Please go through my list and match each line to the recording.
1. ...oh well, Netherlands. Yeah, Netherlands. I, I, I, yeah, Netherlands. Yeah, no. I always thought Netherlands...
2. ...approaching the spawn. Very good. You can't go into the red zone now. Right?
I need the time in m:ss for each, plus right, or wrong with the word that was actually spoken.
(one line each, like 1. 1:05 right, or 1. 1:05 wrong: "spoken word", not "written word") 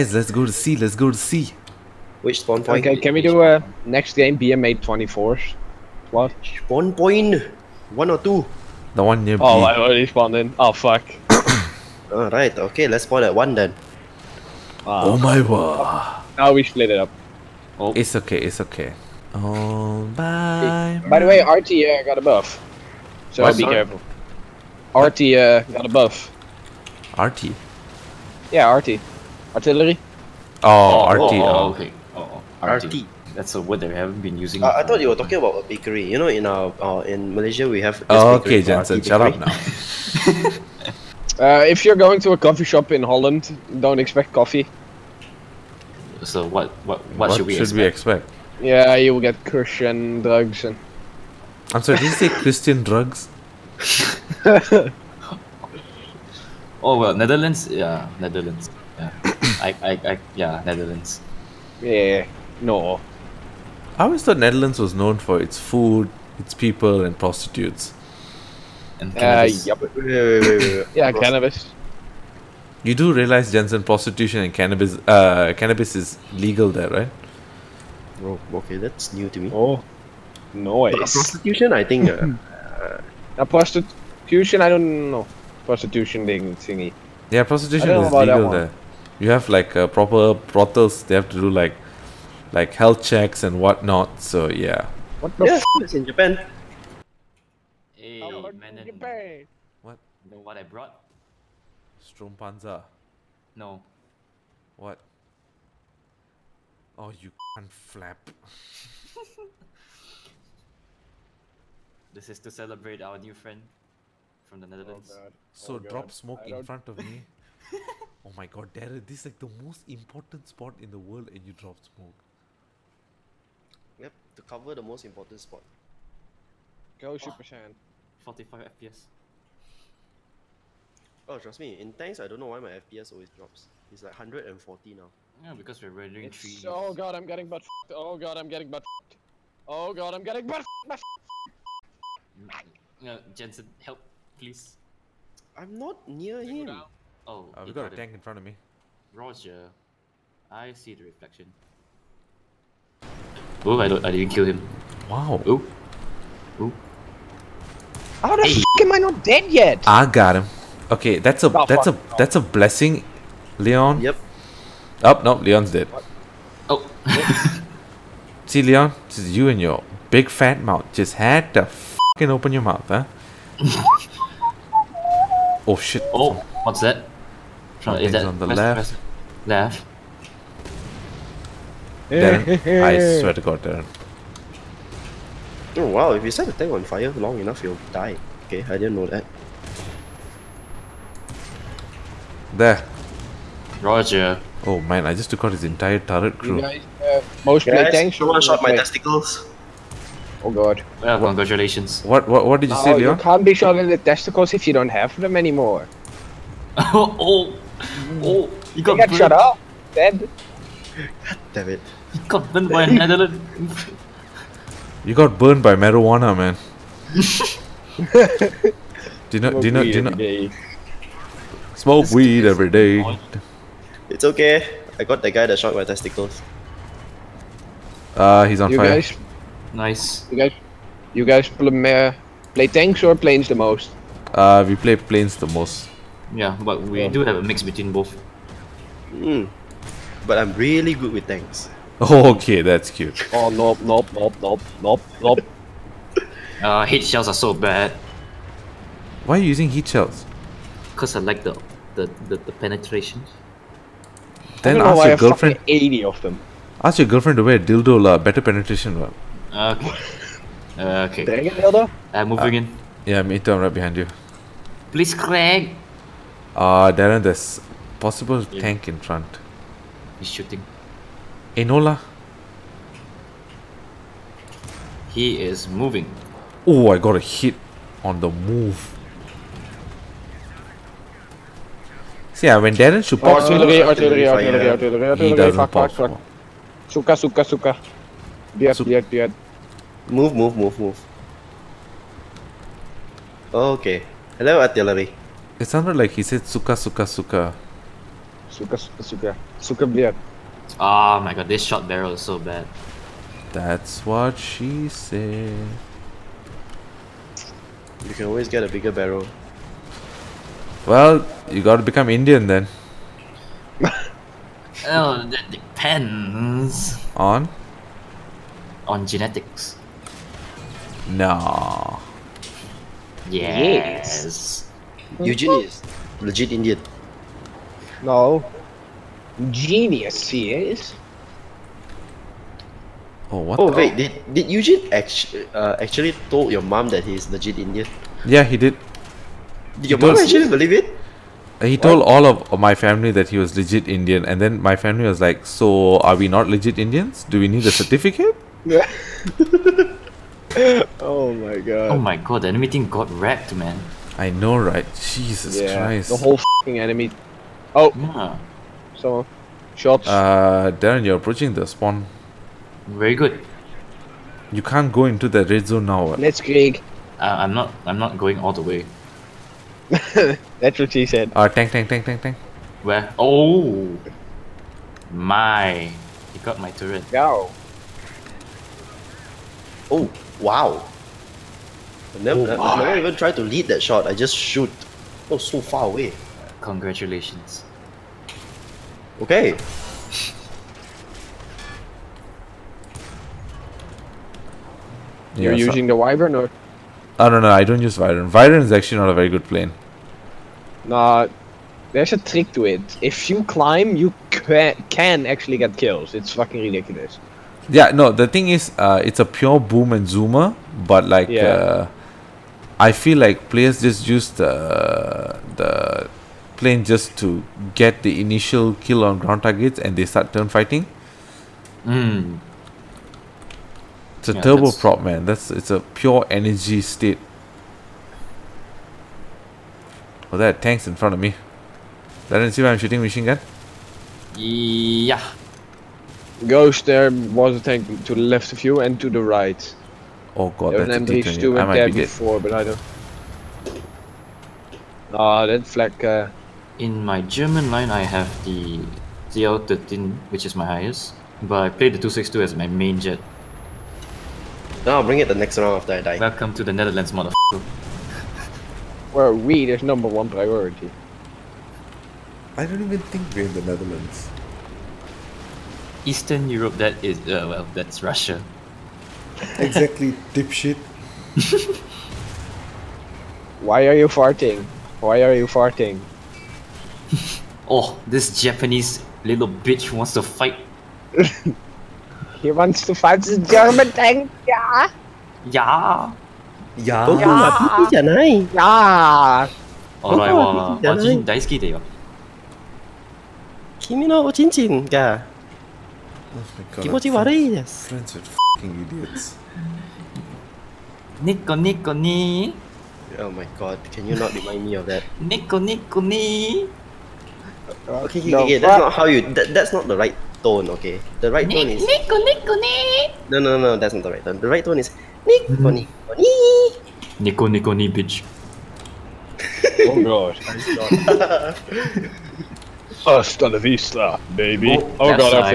1. 0:54 right
2. 6:01 right.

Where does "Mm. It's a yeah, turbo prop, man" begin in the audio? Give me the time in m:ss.
7:01.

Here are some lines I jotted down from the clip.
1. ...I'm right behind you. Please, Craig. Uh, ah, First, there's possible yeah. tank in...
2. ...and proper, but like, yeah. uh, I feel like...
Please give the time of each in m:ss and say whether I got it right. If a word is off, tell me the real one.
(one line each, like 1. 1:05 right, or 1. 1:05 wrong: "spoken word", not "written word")
1. 4:23 wrong: "Darren", not "First"
2. 6:49 wrong: "zoomer", not "proper".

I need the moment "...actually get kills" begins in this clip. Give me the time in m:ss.
6:45.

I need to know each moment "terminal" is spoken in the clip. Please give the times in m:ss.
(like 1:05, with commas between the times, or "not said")
not said.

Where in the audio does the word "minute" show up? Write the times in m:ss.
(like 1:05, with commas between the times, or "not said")
not said.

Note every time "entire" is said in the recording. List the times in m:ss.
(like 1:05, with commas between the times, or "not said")
3:15.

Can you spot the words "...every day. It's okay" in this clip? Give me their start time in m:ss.
3:42.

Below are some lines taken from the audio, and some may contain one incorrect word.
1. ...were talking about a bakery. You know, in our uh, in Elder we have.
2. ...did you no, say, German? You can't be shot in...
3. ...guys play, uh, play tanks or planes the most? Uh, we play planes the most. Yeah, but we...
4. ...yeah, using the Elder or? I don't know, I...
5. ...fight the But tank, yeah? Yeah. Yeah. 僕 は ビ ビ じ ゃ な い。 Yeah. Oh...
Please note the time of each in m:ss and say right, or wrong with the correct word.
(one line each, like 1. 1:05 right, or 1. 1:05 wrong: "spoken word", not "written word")
1. 0:35 wrong: "Malaysia", not "Elder"
2. 3:22 wrong: "Leon", not "German"
3. 3:51 right
4. 6:35 wrong: "Wyvern", not "Elder"
5. 8:02 wrong: "German", not "But".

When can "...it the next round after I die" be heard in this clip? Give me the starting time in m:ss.
7:35.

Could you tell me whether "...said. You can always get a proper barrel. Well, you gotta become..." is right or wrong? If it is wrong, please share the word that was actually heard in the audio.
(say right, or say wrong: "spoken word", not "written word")
wrong: "bigger", not "proper".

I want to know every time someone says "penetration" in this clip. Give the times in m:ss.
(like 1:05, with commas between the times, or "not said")
4:12, 4:18.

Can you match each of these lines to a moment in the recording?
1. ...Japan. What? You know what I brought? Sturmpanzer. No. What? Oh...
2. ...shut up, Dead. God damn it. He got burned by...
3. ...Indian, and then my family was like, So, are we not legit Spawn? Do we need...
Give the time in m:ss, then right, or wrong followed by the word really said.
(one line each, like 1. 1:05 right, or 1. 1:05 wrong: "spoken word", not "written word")
1. 1:38 right
2. 3:29 right
3. 5:43 wrong: "Indians", not "Spawn".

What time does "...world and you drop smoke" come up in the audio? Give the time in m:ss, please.
2:00.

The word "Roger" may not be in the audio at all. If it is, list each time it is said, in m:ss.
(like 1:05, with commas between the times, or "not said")
2:29, 3:13.